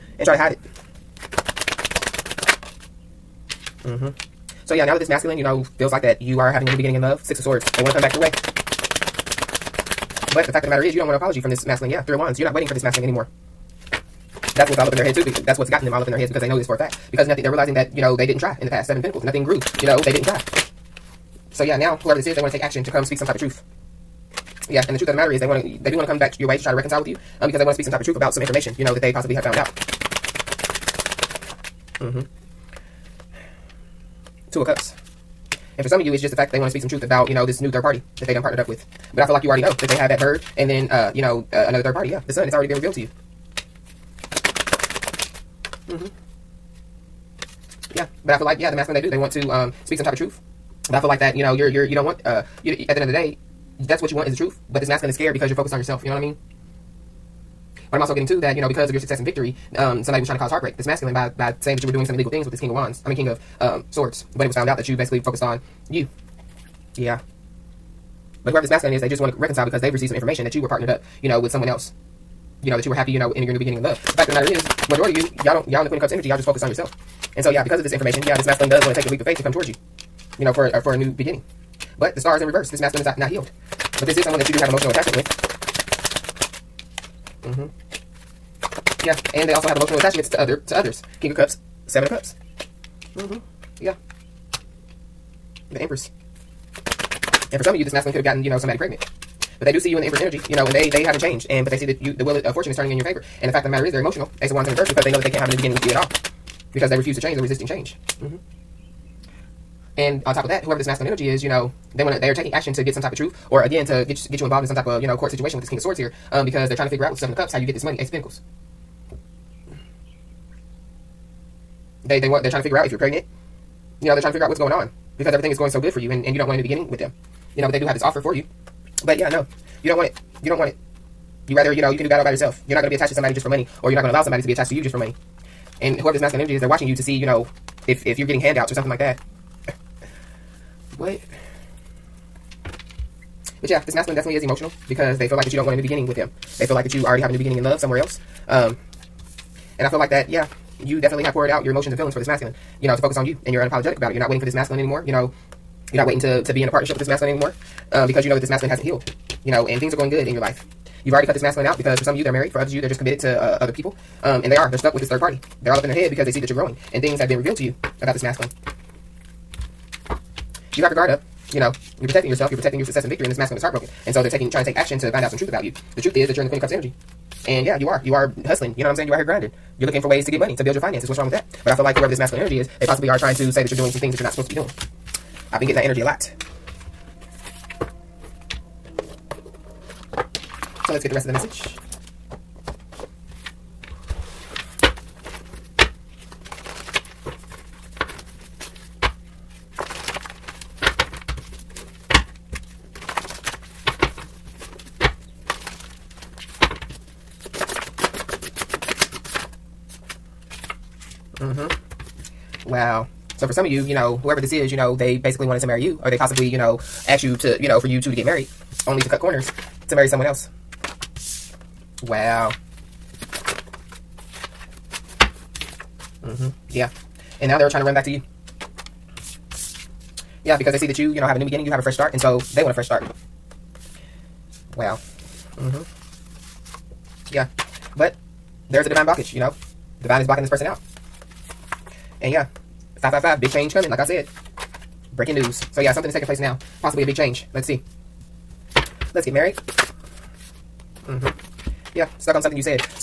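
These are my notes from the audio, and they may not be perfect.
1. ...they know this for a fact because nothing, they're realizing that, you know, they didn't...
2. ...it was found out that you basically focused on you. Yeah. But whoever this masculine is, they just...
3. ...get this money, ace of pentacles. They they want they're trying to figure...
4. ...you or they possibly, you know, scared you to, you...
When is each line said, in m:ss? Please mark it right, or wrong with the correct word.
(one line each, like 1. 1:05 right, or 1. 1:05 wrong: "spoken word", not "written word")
1. 0:16 right
2. 1:04 right
3. 1:57 right
4. 3:35 wrong: "asked", not "scared".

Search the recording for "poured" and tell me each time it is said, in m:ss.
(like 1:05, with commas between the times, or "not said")
2:31.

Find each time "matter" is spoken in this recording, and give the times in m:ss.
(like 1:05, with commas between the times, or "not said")
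0:10, 0:25, 1:14, 1:43.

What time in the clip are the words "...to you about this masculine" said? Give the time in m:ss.
2:47.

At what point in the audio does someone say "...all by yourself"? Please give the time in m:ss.
2:12.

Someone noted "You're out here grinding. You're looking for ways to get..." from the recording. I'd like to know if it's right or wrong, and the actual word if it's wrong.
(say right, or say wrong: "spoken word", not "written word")
right.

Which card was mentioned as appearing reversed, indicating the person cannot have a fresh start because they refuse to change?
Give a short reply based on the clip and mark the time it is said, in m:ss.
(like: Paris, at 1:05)
Ace of Wands, at 1:44.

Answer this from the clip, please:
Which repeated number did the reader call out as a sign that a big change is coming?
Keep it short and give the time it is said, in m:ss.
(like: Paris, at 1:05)
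555, at 4:02.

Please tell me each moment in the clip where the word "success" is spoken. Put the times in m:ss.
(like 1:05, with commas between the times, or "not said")
0:58, 2:52.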